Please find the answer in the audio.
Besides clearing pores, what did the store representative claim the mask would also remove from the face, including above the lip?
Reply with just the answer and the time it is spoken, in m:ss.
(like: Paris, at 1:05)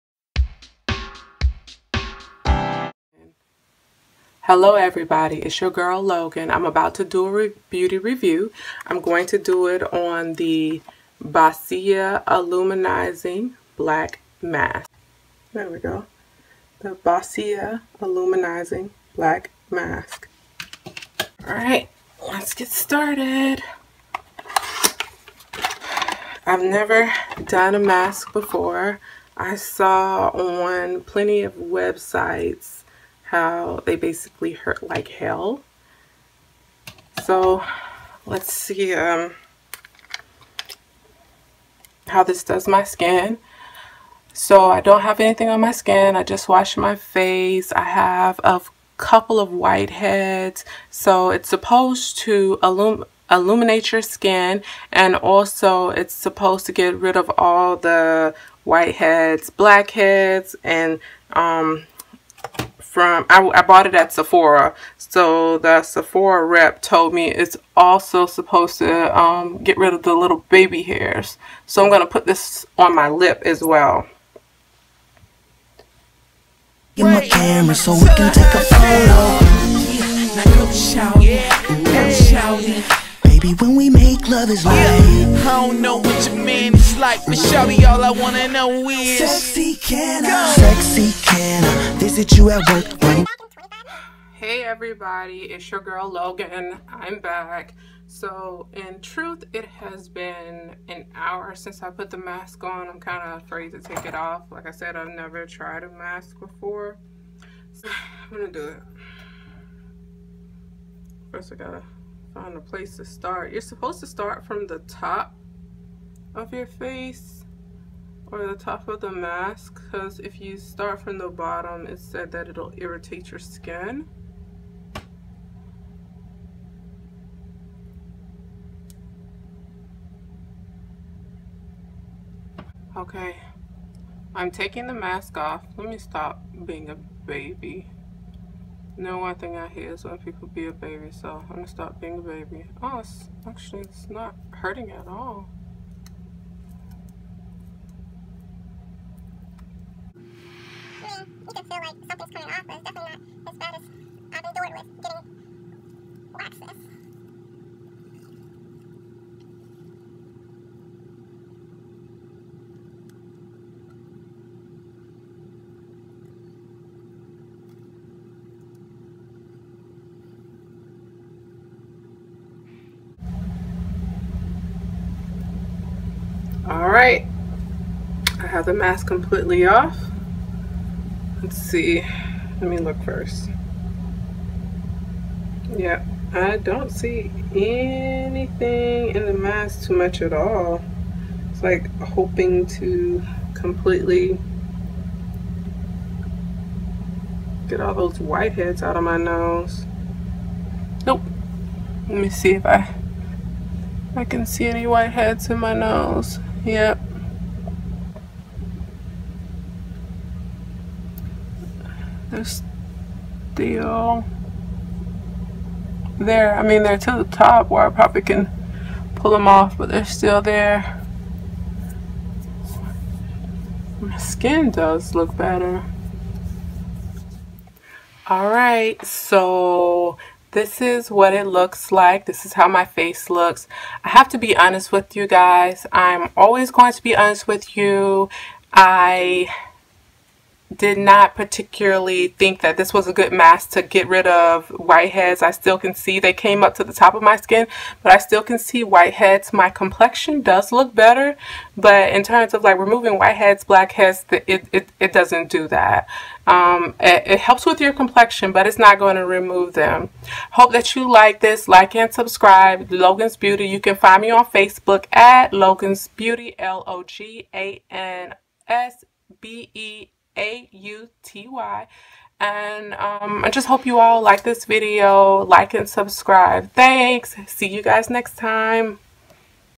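baby hairs, at 1:10.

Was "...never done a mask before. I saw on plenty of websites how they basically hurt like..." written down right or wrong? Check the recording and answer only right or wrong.
right.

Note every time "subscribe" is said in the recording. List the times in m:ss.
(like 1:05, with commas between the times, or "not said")
4:22, 4:35.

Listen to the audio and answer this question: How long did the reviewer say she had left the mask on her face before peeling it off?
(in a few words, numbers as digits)
an hour.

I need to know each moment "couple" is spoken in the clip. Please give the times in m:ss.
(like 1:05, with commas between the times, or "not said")
0:48.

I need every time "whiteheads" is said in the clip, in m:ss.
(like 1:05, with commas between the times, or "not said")
0:49, 0:58, 3:18, 3:24, 4:04, 4:08, 4:13.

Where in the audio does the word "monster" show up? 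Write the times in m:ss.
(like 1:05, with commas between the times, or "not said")
not said.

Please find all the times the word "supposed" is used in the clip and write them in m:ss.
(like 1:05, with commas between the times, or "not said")
0:51, 0:56, 1:08, 1:53.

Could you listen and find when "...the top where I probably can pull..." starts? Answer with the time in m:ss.
3:37.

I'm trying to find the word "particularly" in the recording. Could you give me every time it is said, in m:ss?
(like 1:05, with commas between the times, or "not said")
4:01.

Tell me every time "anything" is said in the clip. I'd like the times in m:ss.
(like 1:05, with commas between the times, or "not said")
0:45, 3:07.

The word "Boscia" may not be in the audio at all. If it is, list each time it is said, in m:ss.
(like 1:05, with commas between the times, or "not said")
0:11, 0:16.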